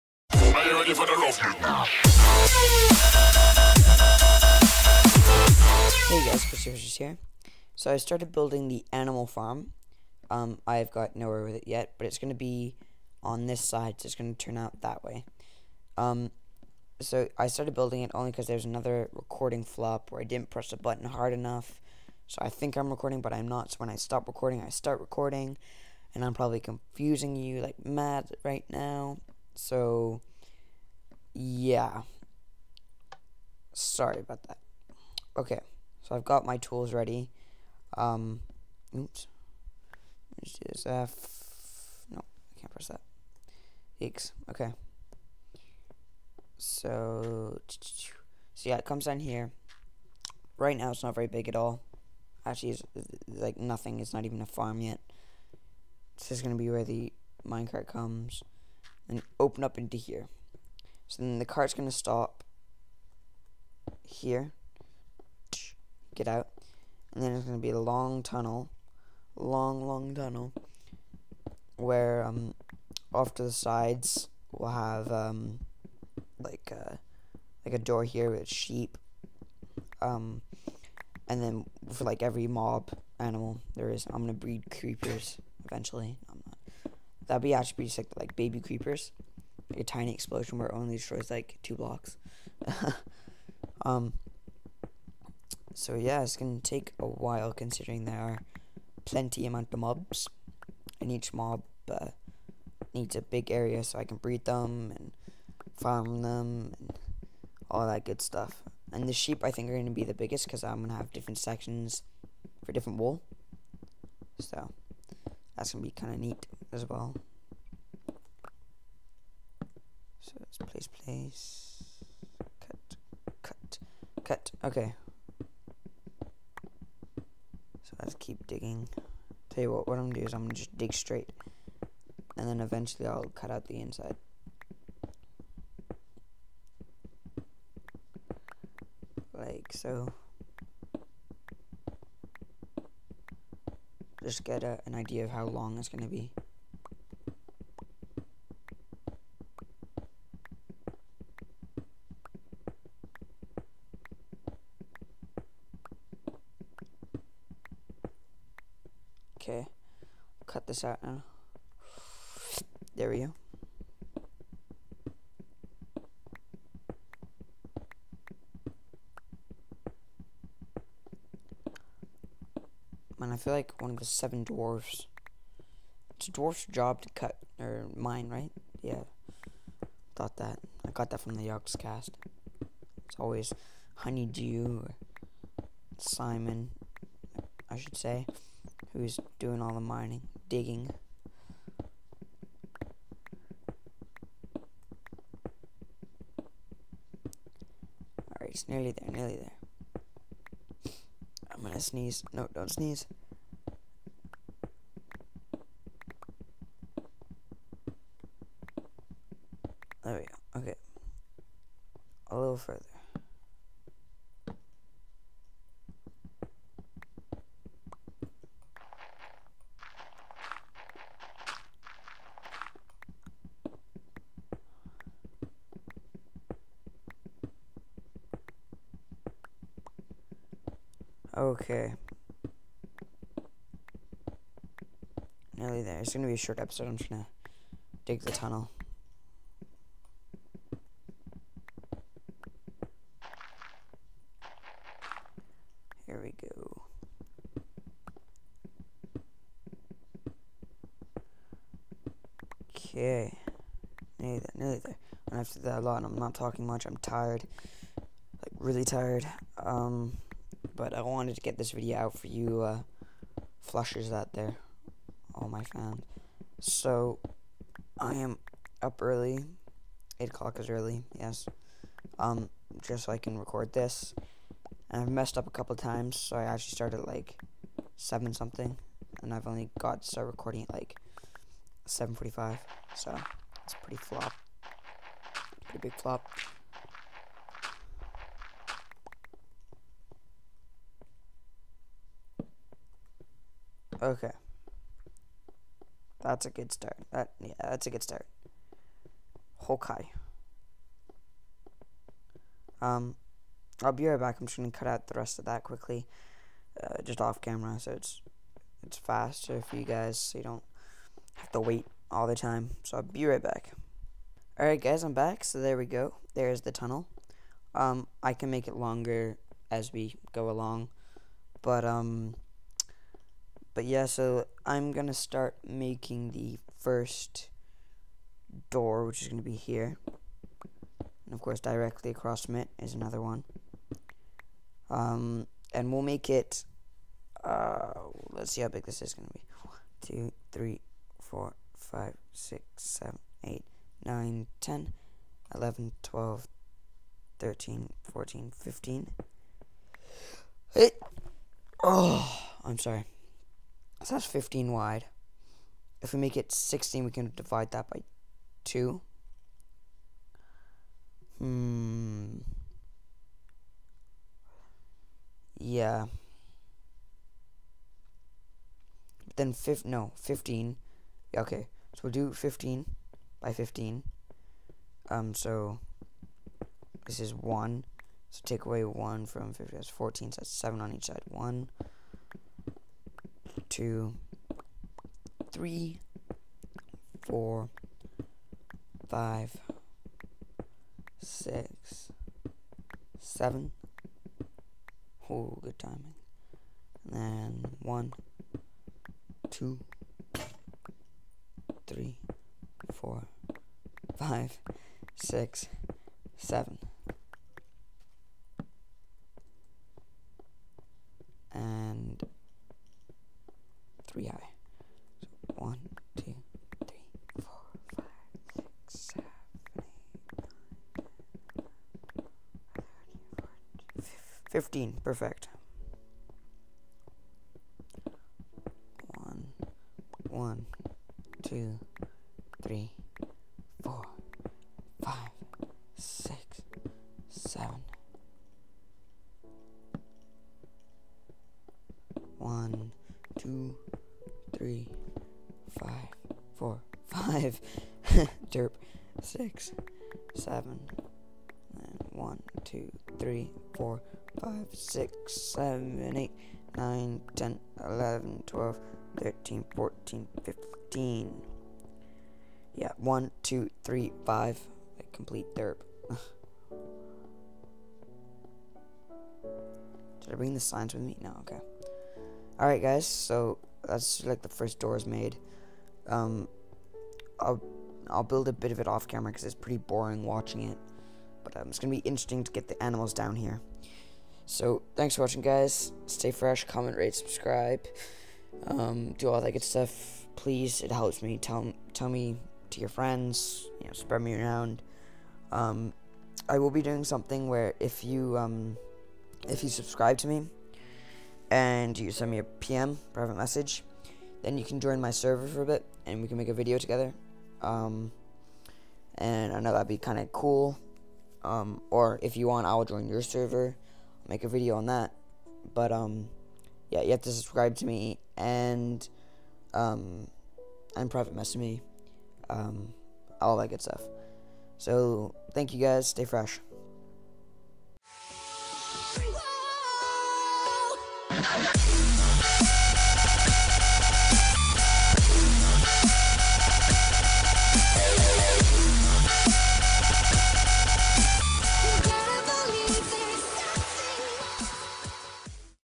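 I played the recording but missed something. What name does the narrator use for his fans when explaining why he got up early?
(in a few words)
Flushers.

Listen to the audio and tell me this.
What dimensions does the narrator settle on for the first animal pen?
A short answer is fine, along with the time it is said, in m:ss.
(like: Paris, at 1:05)
15 by 15, at 6:12.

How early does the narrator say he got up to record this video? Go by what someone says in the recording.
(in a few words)
8 o'clock.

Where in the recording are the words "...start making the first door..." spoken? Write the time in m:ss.
5:25.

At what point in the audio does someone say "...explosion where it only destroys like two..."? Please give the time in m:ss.
1:30.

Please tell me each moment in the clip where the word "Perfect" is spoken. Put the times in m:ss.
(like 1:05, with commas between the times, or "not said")
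7:05.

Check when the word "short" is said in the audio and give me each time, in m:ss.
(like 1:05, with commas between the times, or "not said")
3:56.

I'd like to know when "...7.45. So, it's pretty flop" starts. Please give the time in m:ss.
4:41.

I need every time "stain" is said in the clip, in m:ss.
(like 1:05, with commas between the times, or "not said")
not said.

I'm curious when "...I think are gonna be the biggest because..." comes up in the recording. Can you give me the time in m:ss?
1:49.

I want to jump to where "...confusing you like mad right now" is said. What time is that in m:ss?
0:26.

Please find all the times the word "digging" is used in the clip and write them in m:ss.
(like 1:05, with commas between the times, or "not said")
2:08, 3:10.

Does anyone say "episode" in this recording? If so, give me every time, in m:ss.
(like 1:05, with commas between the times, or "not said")
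3:56.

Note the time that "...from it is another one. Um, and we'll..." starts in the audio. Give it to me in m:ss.
5:32.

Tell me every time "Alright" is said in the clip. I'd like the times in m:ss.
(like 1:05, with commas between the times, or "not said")
3:18, 7:52.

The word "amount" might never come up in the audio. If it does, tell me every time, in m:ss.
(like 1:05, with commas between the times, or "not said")
1:39.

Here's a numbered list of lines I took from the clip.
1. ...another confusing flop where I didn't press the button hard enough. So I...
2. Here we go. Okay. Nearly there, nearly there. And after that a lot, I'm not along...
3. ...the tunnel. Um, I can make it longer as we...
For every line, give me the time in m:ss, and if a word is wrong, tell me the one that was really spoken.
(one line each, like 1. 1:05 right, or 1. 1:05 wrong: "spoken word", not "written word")
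1. 0:18 wrong: "recording", not "confusing"
2. 4:06 wrong: "talking", not "along"
3. 5:16 right.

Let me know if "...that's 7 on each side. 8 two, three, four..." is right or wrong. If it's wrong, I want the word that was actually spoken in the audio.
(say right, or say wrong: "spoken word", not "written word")
wrong: "1", not "8".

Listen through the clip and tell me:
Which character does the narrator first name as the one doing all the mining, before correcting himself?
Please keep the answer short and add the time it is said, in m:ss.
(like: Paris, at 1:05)
Honeydew, at 3:03.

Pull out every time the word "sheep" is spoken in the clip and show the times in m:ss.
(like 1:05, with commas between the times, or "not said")
1:18, 1:49.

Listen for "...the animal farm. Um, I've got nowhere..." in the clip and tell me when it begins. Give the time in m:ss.
0:08.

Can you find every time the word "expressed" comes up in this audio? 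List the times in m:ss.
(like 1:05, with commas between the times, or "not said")
not said.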